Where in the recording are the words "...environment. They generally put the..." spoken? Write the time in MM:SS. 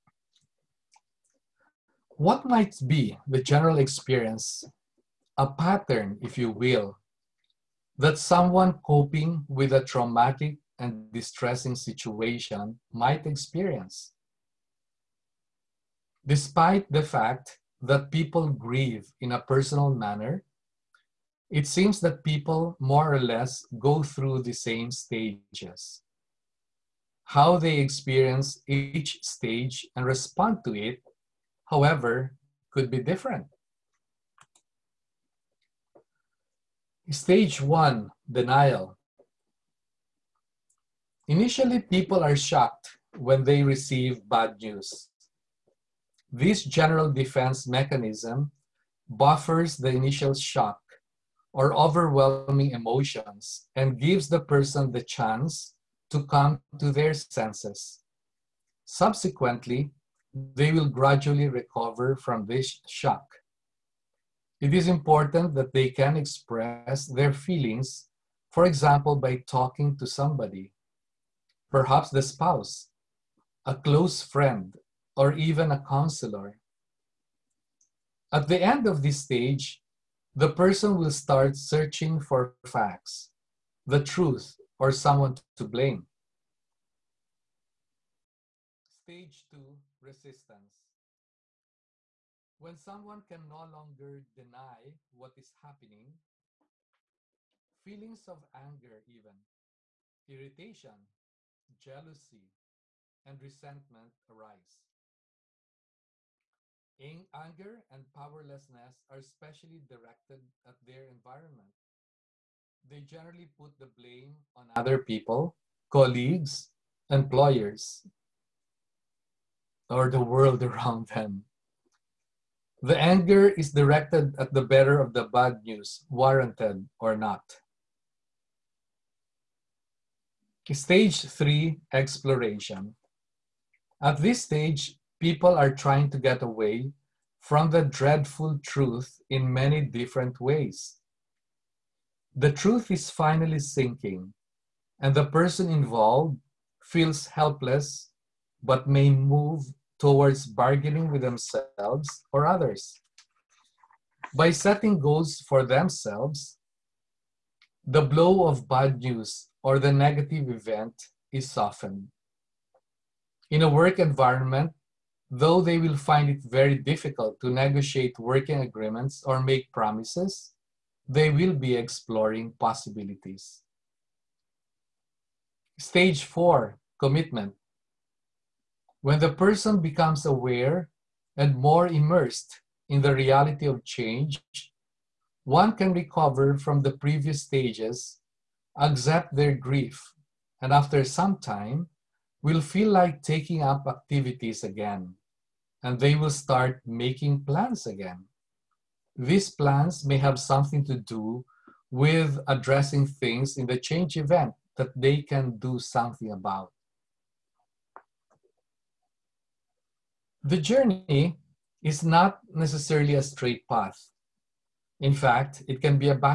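01:51.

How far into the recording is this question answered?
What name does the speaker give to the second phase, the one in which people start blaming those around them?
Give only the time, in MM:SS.
01:29.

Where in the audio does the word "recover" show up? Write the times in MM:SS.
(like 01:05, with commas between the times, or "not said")
01:01, 03:05.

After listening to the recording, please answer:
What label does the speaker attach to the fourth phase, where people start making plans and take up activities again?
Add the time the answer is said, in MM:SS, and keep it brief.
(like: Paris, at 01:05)
commitment, at 02:56.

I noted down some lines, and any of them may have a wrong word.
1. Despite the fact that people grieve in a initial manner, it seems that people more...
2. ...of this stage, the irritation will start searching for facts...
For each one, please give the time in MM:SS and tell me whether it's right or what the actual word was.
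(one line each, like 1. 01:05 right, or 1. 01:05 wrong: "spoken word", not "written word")
1. 00:16 wrong: "personal", not "initial"
2. 01:18 wrong: "person", not "irritation".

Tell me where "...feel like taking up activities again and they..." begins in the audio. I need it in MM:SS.
03:12.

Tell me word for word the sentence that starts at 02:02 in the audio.
The anger is directed at the bearer of the bad news, warranted or not.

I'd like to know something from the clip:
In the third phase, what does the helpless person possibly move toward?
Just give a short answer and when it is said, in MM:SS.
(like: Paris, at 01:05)
bargaining, at 02:30.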